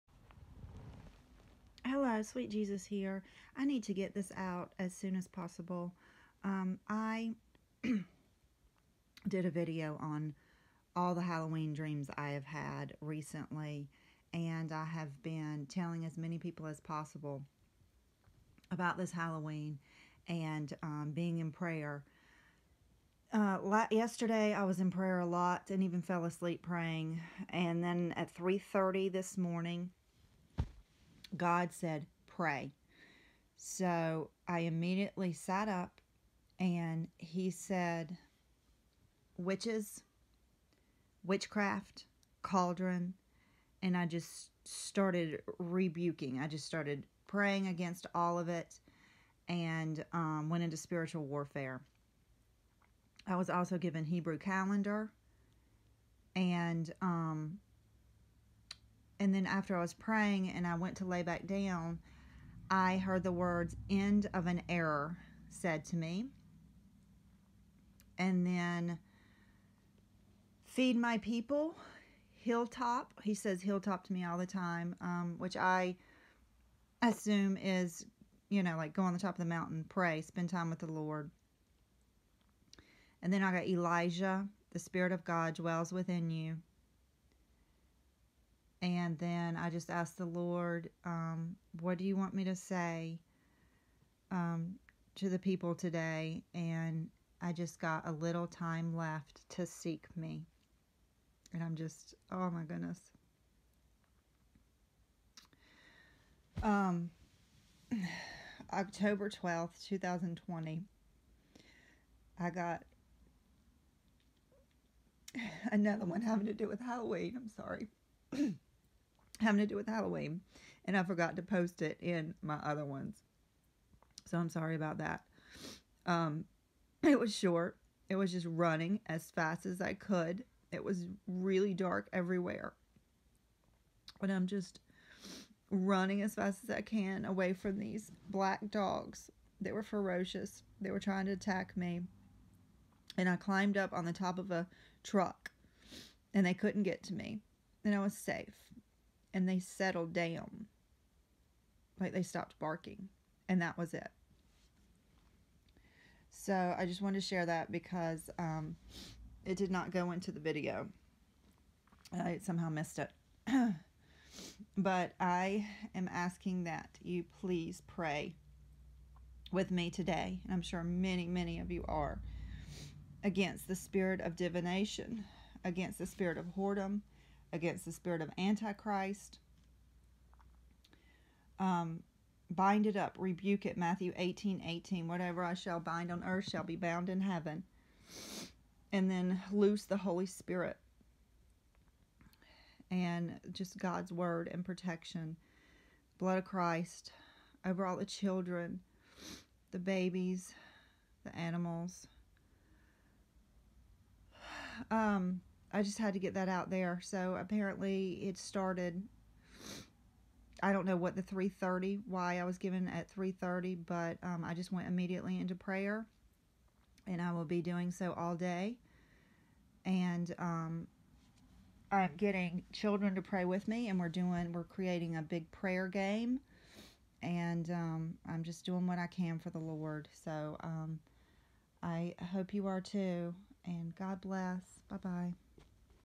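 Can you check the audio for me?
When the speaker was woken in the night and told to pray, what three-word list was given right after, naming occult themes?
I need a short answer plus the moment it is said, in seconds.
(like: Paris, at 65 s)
Witches, witchcraft, cauldron, at 39 s.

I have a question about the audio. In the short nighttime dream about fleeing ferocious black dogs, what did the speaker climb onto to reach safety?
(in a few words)
A truck.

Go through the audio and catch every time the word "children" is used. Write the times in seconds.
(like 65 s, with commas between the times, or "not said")
198 s, 222 s.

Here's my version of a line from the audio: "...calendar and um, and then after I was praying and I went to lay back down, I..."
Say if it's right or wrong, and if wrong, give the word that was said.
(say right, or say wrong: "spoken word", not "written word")
right.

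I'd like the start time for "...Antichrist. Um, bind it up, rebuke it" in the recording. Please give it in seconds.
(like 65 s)
178 s.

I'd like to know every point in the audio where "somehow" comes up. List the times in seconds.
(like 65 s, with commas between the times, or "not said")
162 s.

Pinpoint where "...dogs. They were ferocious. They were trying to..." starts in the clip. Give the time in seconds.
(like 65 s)
138 s.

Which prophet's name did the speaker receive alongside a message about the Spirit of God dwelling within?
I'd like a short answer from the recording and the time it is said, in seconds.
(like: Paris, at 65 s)
Elijah, at 83 s.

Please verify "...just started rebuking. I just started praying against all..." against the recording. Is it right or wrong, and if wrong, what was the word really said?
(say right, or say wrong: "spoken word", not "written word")
right.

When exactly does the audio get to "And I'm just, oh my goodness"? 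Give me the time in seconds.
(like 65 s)
101 s.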